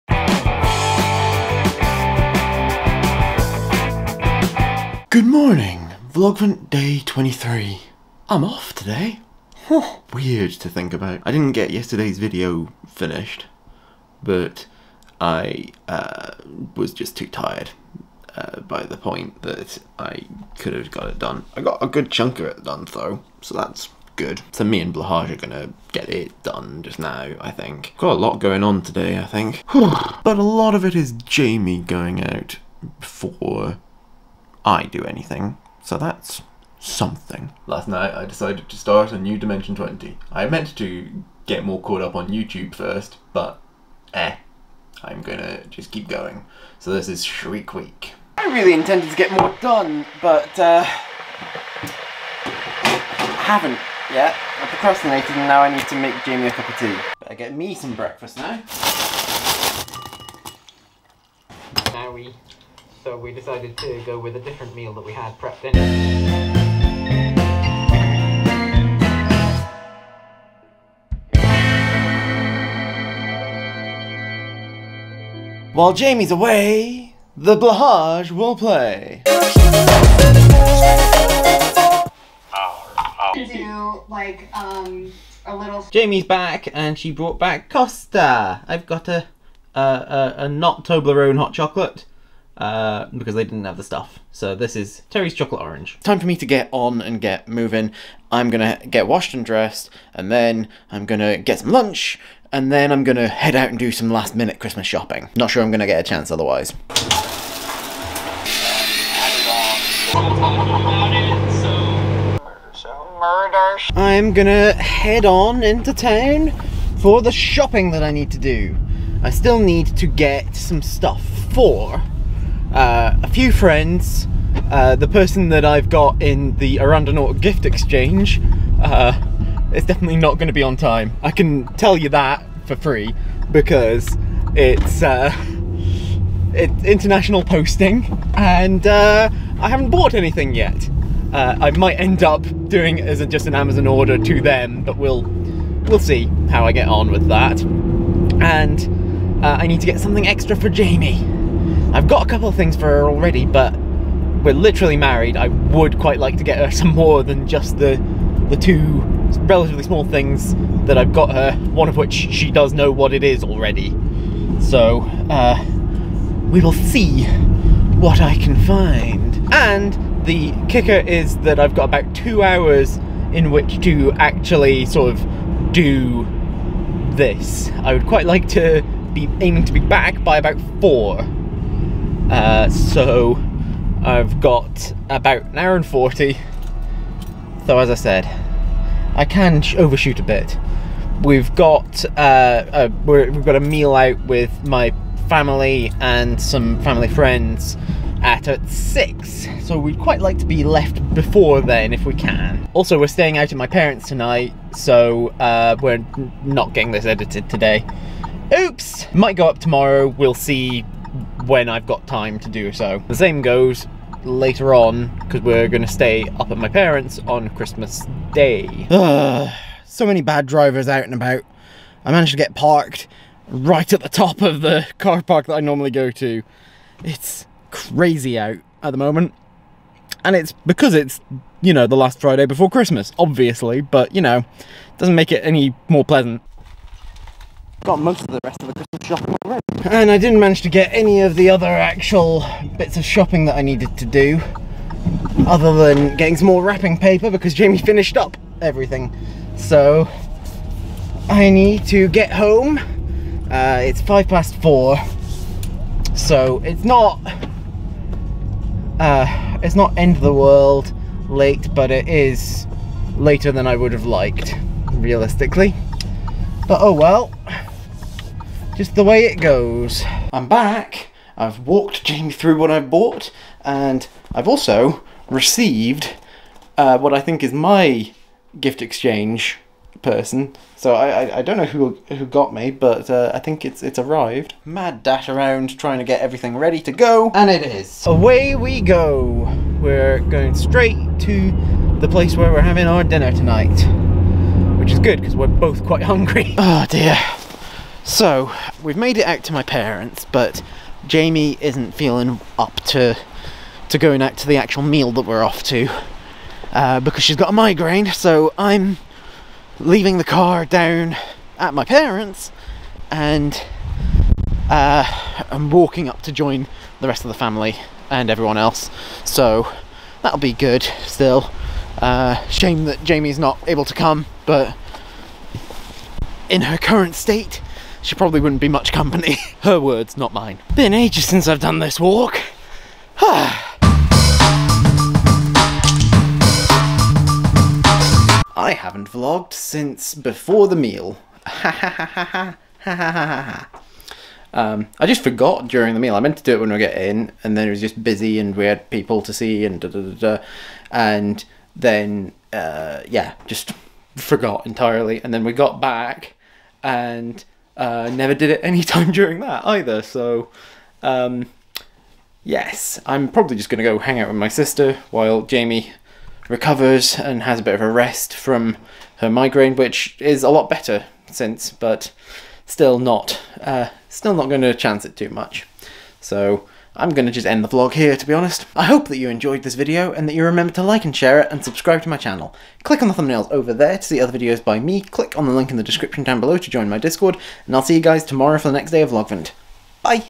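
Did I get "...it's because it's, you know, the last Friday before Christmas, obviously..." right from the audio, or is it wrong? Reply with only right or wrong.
right.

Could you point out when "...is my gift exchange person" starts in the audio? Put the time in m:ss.
4:37.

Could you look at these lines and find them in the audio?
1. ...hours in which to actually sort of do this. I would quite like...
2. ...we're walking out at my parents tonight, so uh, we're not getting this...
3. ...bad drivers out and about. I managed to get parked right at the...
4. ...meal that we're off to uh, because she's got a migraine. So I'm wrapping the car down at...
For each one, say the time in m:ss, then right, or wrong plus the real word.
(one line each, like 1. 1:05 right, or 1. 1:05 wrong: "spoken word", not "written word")
1. 2:52 right
2. 3:22 wrong: "staying", not "walking"
3. 3:40 right
4. 5:04 wrong: "leaving", not "wrapping".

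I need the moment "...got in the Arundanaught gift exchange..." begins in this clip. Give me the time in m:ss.
2:05.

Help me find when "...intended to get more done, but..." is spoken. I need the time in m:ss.
0:48.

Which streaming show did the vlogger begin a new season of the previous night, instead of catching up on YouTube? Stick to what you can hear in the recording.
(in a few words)
Dimension 20.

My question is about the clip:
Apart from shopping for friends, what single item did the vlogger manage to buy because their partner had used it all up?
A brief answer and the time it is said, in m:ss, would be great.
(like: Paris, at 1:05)
wrapping paper, at 4:06.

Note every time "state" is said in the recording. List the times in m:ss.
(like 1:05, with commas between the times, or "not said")
5:27.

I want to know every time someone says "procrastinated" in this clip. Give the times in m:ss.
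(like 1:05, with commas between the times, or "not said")
0:54.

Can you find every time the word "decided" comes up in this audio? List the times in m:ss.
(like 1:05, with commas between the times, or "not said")
0:38, 1:03.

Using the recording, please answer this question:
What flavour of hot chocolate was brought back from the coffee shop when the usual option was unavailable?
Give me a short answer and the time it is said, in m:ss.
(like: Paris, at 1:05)
Terry's Chocolate Orange, at 1:35.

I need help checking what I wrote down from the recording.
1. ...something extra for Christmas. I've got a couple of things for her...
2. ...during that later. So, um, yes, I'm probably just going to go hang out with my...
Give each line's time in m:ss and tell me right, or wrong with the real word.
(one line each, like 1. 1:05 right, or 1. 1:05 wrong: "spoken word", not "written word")
1. 2:29 wrong: "Jamie", not "Christmas"
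2. 5:59 wrong: "either", not "later".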